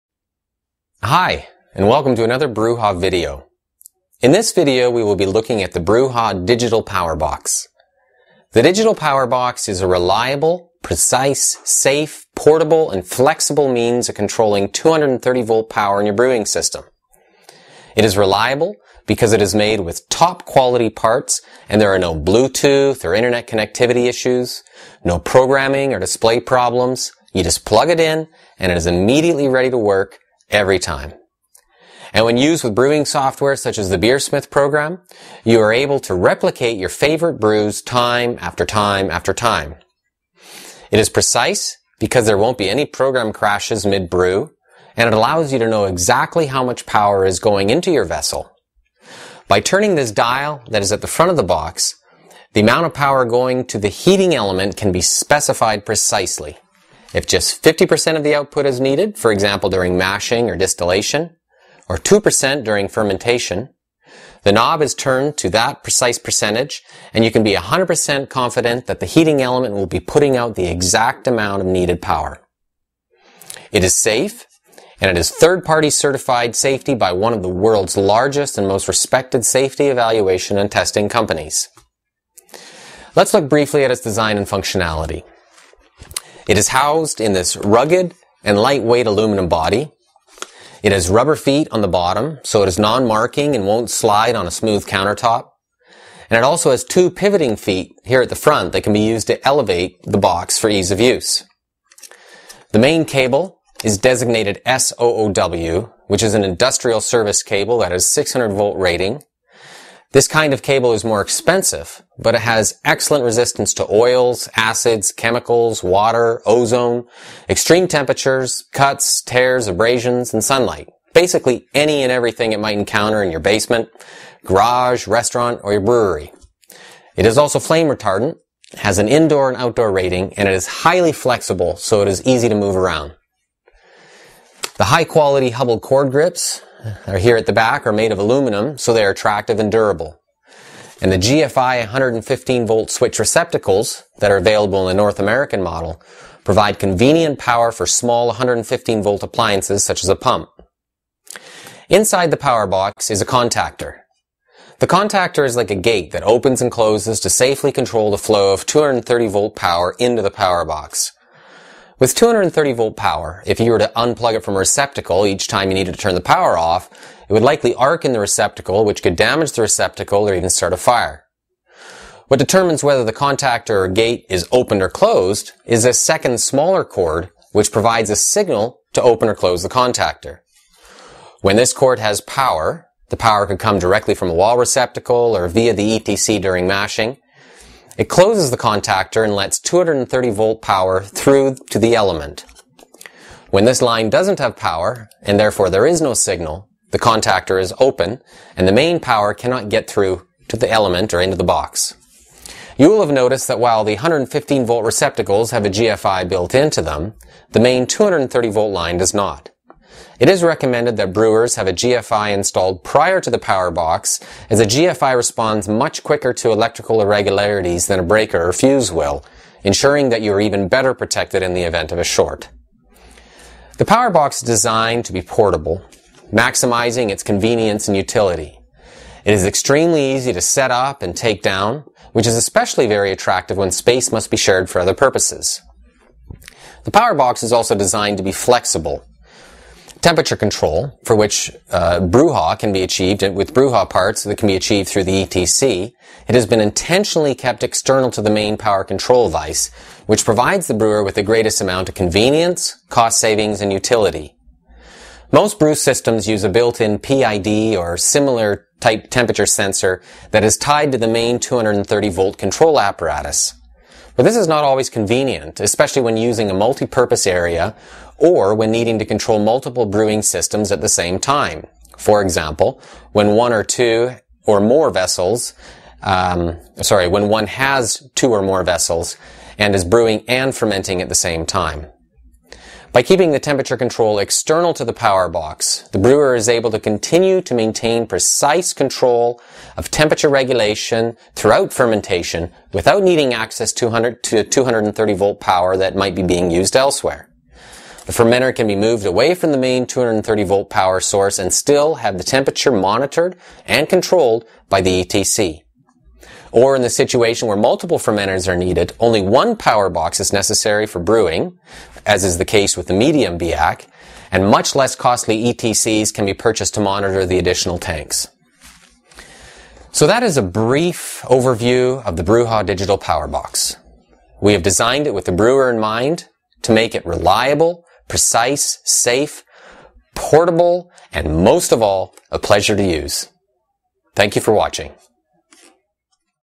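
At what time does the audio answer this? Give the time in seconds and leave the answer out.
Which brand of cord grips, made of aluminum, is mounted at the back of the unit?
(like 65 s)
135 s.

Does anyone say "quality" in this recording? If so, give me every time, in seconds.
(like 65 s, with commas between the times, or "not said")
20 s, 135 s.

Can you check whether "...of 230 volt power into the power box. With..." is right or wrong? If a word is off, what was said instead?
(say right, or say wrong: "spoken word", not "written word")
right.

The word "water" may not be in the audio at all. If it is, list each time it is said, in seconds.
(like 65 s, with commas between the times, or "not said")
115 s.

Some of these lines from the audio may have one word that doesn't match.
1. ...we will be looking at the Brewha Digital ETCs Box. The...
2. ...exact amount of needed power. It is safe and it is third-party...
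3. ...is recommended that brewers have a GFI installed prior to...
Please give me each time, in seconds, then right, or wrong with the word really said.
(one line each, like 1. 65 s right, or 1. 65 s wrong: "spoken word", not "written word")
1. 4 s wrong: "Power", not "ETCs"
2. 70 s right
3. 210 s right.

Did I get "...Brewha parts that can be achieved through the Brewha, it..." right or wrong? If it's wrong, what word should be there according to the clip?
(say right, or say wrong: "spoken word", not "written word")
wrong: "ETC", not "Brewha".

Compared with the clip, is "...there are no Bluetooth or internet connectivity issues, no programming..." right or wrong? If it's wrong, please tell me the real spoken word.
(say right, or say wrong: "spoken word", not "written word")
right.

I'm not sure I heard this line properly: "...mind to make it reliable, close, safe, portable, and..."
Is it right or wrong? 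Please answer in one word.
wrong.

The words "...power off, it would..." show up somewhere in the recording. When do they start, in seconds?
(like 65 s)
166 s.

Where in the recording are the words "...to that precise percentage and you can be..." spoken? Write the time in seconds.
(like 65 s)
65 s.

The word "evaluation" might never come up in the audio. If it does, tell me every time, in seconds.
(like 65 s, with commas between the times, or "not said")
79 s.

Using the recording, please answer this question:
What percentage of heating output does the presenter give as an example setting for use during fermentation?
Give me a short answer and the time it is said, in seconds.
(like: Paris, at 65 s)
2%, at 61 s.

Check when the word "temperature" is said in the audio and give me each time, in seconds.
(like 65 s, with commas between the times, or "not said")
117 s, 240 s, 259 s, 283 s, 289 s, 302 s.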